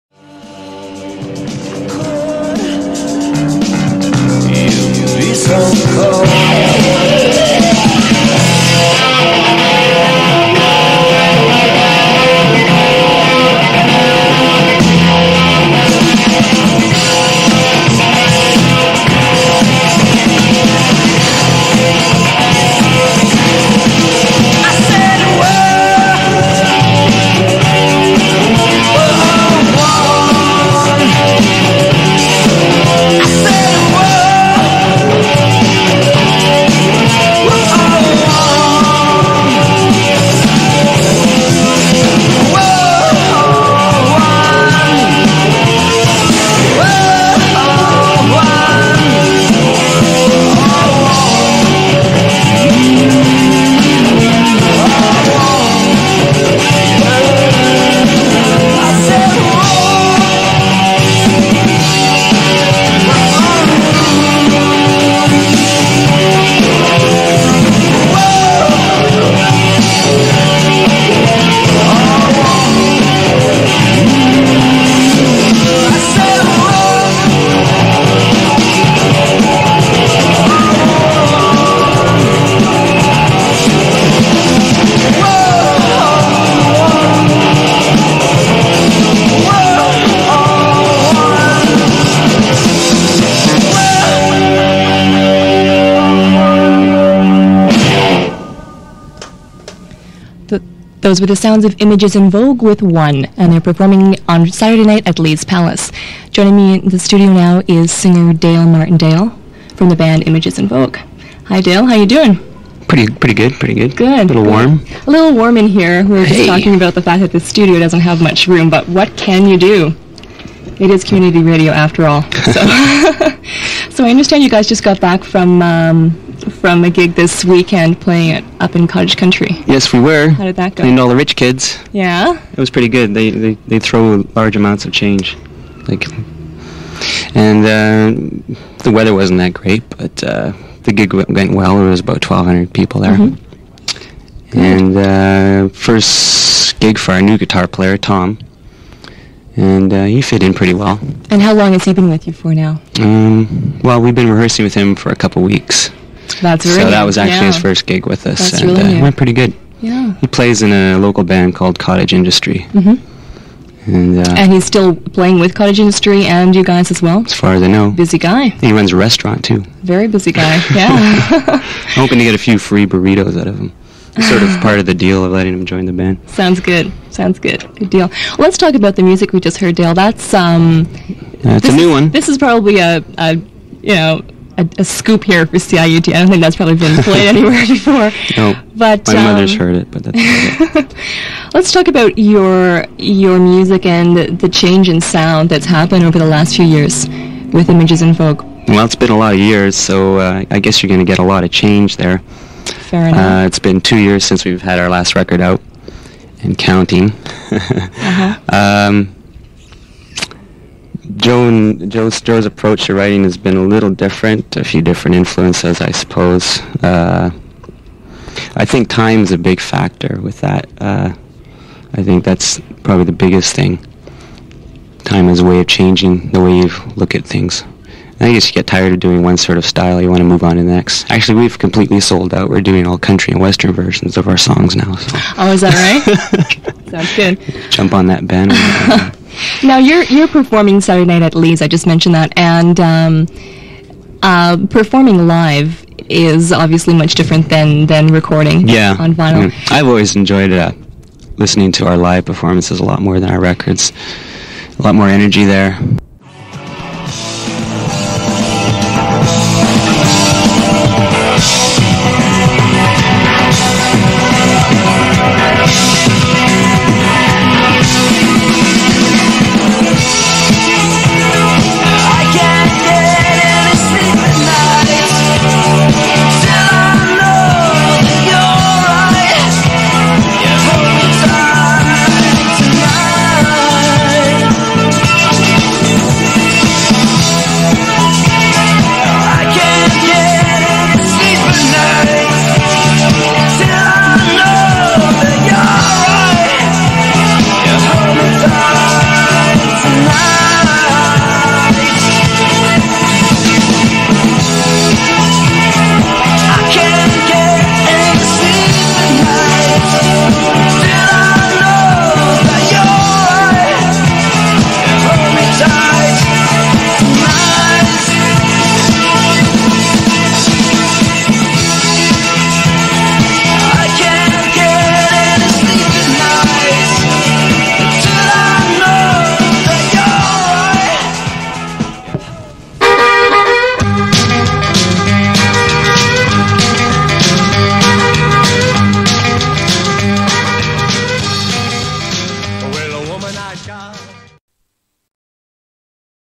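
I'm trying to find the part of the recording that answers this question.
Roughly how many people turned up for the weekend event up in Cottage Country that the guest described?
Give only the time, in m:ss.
2:22.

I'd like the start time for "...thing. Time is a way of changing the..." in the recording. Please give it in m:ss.
3:43.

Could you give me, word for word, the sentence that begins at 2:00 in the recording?
It is community radio after all.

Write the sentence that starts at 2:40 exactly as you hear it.
He plays in a local band called Cottage Industry.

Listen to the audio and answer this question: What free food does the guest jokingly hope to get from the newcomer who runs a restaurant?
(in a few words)
Burritos.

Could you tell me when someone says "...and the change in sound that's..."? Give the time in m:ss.
3:13.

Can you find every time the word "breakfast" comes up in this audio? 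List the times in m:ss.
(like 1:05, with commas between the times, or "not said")
not said.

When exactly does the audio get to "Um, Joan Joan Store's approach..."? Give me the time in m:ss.
3:28.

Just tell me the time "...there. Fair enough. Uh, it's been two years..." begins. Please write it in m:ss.
3:21.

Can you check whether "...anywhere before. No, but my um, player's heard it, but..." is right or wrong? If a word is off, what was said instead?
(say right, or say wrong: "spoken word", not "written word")
wrong: "mother", not "player".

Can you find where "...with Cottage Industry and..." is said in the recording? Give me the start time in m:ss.
2:45.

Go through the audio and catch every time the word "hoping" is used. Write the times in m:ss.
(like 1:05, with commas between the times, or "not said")
2:51.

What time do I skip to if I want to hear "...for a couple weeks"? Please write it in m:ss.
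2:34.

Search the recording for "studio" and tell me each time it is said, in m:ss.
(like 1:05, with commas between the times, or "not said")
1:46, 1:57.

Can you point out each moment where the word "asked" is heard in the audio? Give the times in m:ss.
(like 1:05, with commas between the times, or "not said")
not said.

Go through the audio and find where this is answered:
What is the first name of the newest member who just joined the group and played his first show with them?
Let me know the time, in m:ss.
2:27.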